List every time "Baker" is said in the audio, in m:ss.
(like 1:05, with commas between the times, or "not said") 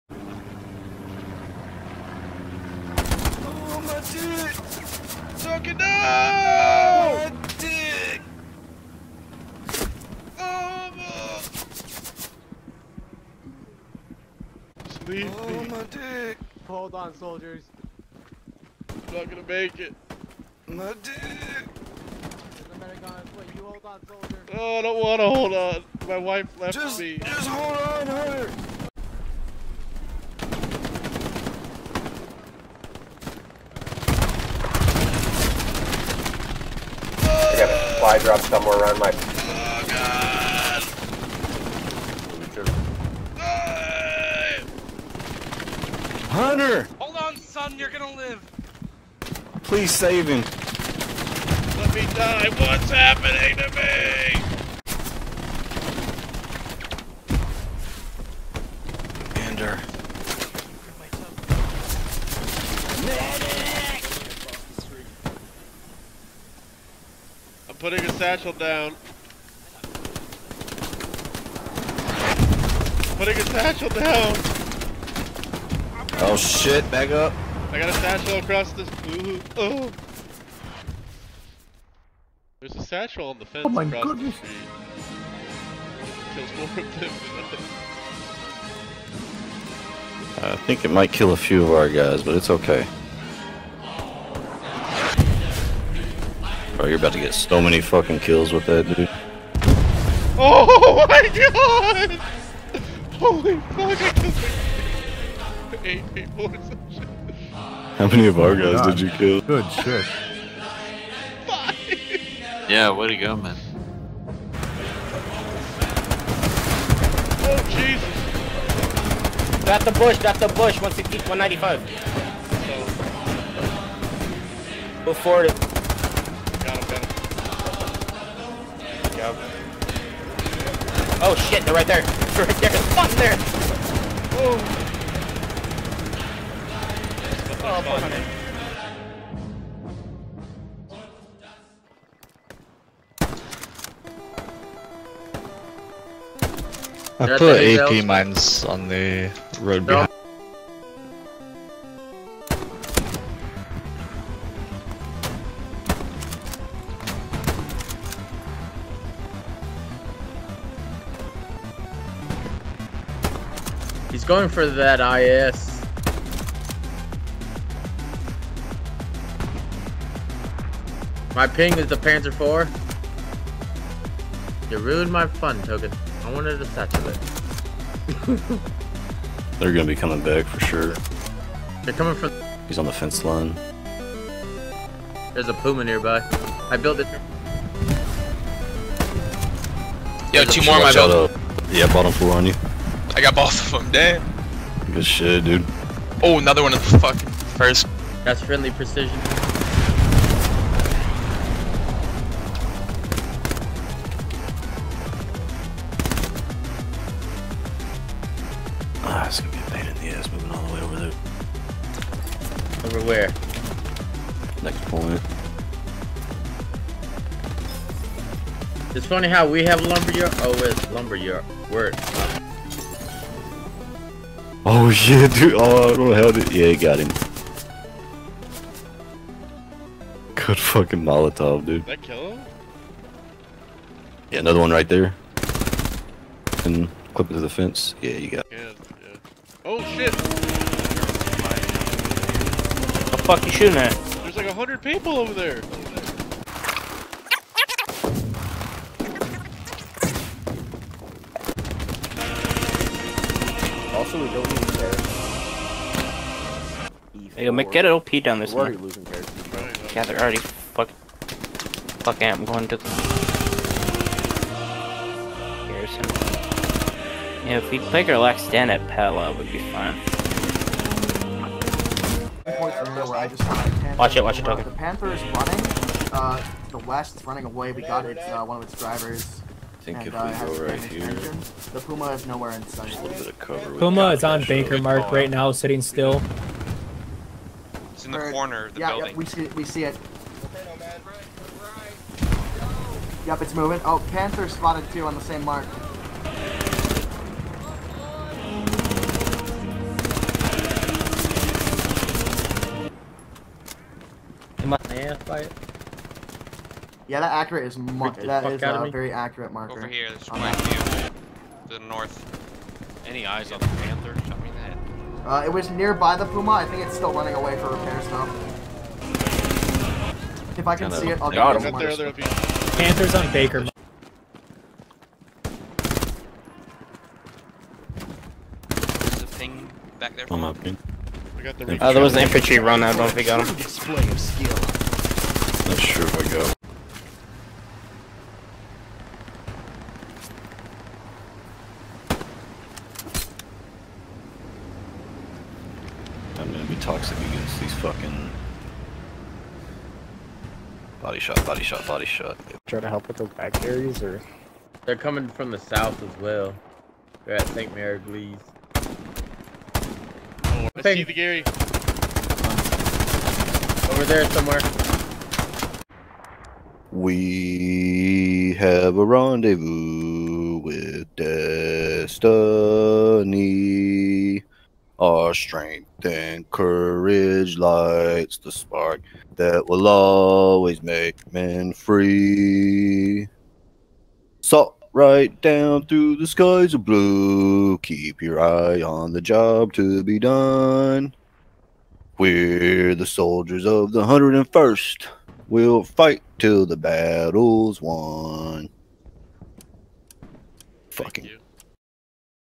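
4:44, 5:23.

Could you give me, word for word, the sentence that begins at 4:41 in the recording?
The Puma is nowhere in sight.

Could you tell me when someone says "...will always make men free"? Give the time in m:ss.
6:19.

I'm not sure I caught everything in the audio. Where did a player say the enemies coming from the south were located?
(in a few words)
St. Mère-Église.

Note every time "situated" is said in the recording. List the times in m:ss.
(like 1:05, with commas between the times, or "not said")
not said.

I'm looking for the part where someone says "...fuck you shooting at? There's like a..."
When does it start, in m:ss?
4:03.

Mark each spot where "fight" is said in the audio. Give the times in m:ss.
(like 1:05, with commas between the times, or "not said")
5:05, 6:35.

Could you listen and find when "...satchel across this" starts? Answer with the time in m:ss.
1:17.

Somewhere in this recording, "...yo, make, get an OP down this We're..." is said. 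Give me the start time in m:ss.
4:17.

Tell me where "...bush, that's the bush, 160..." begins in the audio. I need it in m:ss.
1:59.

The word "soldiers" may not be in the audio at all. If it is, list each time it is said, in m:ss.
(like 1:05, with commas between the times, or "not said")
0:17, 6:33.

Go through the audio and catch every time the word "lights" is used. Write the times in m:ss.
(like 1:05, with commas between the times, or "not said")
6:17.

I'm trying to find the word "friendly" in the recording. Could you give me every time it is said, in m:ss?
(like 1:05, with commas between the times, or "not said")
3:18.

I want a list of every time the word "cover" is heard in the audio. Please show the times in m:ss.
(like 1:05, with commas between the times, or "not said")
4:43.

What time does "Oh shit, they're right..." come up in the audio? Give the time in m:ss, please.
2:11.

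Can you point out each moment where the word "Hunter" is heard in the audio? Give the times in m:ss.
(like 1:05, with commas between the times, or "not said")
0:46.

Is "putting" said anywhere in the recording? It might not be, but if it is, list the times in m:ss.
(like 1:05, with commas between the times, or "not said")
1:07, 1:13.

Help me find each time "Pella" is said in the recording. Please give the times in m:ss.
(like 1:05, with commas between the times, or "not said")
4:28.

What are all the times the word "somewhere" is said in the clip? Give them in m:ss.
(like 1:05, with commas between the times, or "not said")
0:38, 6:04.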